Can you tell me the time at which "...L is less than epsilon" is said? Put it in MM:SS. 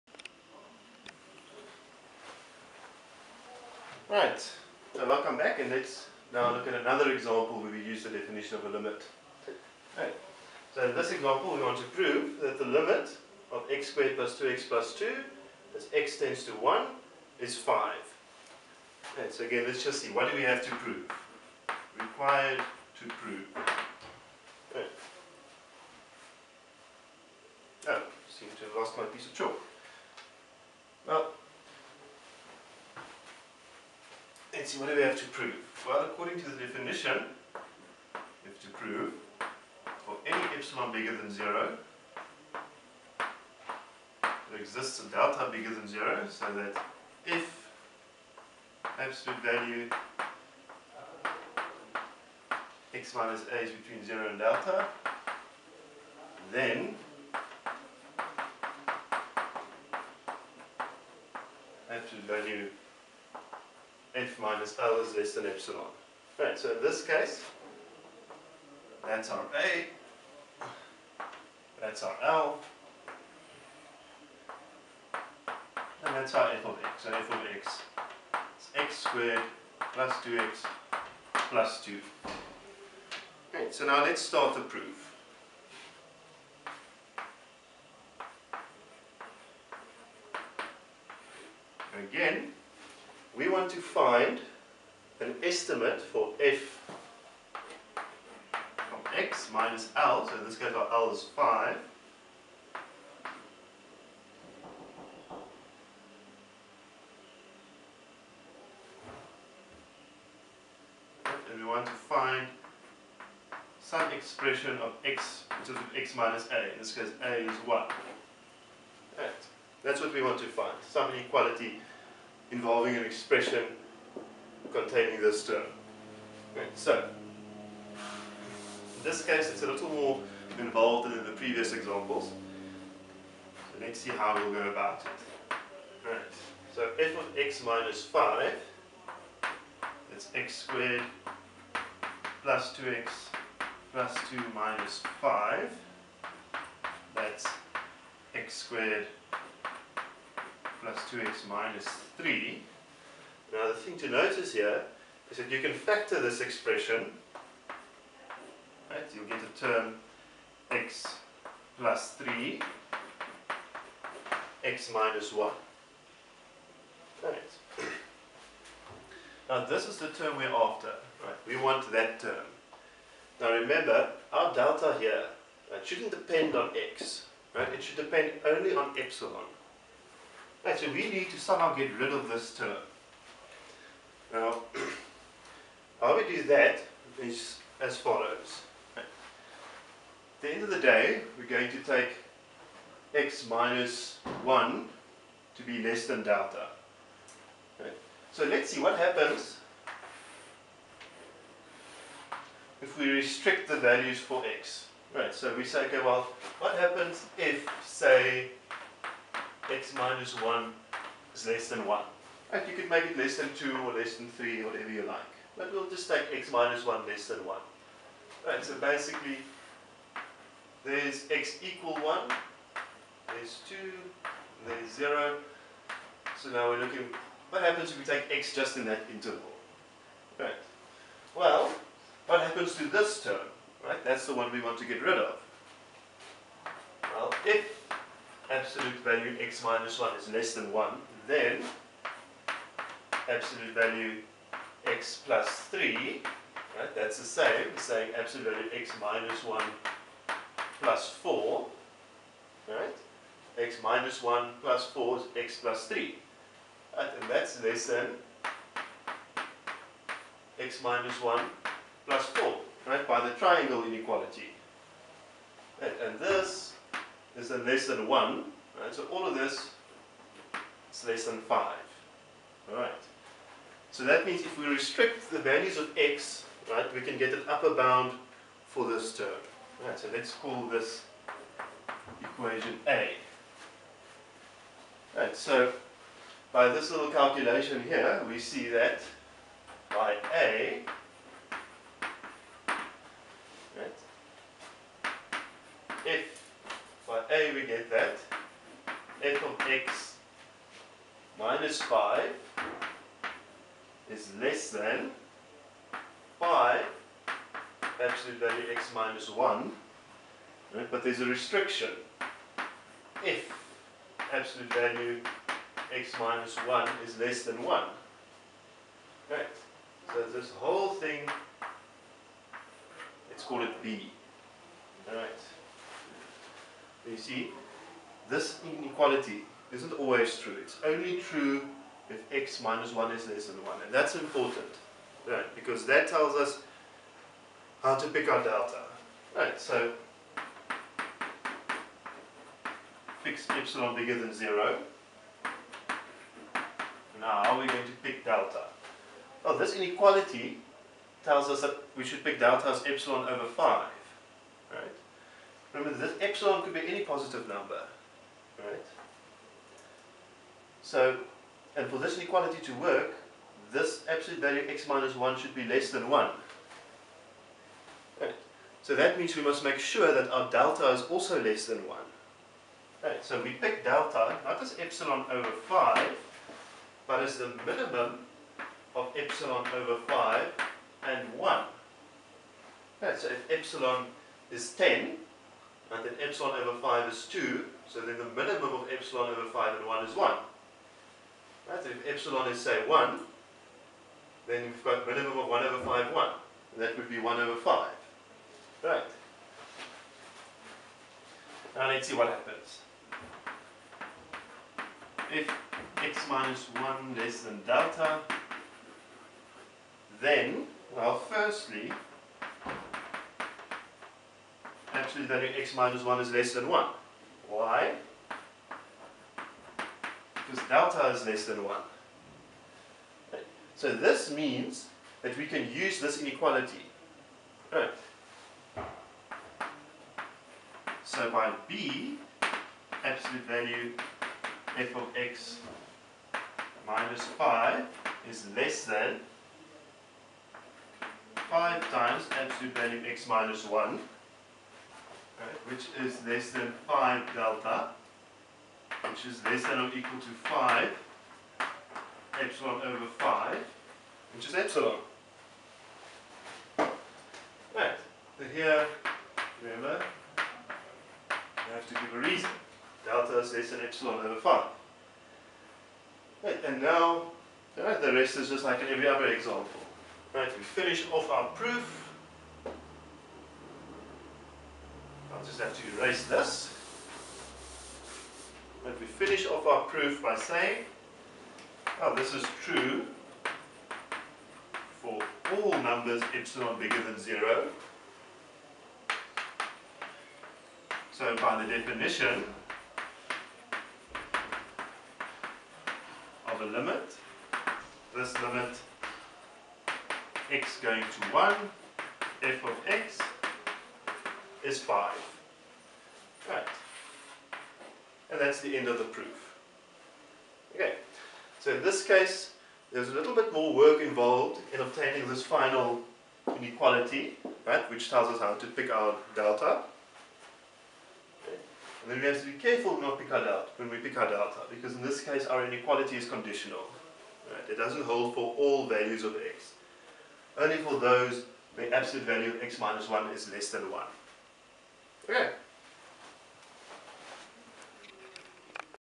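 01:04.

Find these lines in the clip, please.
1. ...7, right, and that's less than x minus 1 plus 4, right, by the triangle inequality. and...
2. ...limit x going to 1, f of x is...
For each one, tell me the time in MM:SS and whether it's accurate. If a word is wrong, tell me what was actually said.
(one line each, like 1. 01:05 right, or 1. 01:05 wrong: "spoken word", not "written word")
1. 04:15 wrong: "3", not "7"
2. 08:18 right.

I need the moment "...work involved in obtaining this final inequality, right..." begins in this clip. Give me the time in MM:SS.
08:33.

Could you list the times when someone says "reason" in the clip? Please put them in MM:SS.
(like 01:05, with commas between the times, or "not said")
07:42.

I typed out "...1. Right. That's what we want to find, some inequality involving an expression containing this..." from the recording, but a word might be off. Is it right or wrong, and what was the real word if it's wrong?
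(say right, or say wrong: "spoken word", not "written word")
right.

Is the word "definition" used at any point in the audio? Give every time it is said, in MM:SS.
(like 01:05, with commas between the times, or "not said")
00:08, 00:36, 08:11.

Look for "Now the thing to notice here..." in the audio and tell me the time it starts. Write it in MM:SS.
02:33.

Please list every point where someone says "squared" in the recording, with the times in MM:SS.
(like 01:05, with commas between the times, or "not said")
00:13, 01:18, 02:20, 02:28.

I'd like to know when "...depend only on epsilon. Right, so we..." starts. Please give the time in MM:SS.
02:57.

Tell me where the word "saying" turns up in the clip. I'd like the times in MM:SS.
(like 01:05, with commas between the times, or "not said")
04:07, 08:00.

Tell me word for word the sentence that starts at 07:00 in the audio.
Because delta is less than 1.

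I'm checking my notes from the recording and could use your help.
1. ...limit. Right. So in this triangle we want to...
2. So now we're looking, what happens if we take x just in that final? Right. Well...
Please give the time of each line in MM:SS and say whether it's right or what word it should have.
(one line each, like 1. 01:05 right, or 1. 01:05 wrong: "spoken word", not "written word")
1. 00:08 wrong: "example", not "triangle"
2. 03:46 wrong: "interval", not "final".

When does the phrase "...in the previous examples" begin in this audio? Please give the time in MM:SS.
02:11.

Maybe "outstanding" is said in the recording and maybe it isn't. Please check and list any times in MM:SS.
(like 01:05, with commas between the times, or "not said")
not said.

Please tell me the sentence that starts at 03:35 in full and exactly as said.
But we'll just take x minus 1 less than 1.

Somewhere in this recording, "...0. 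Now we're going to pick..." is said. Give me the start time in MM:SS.
05:44.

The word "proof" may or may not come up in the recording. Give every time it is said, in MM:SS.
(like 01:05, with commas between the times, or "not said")
01:24, 07:51, 07:59, 08:29.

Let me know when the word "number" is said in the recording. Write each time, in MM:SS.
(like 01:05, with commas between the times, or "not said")
05:57, 08:05.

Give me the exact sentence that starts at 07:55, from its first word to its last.
I'll just have to erase this.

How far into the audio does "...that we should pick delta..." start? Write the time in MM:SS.
05:51.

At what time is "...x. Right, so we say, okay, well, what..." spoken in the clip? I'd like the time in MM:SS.
03:24.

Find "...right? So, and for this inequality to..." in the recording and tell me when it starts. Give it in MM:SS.
05:58.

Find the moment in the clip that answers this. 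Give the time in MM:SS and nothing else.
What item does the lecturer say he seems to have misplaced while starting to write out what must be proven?
00:29.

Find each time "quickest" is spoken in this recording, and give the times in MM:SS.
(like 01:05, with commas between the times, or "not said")
not said.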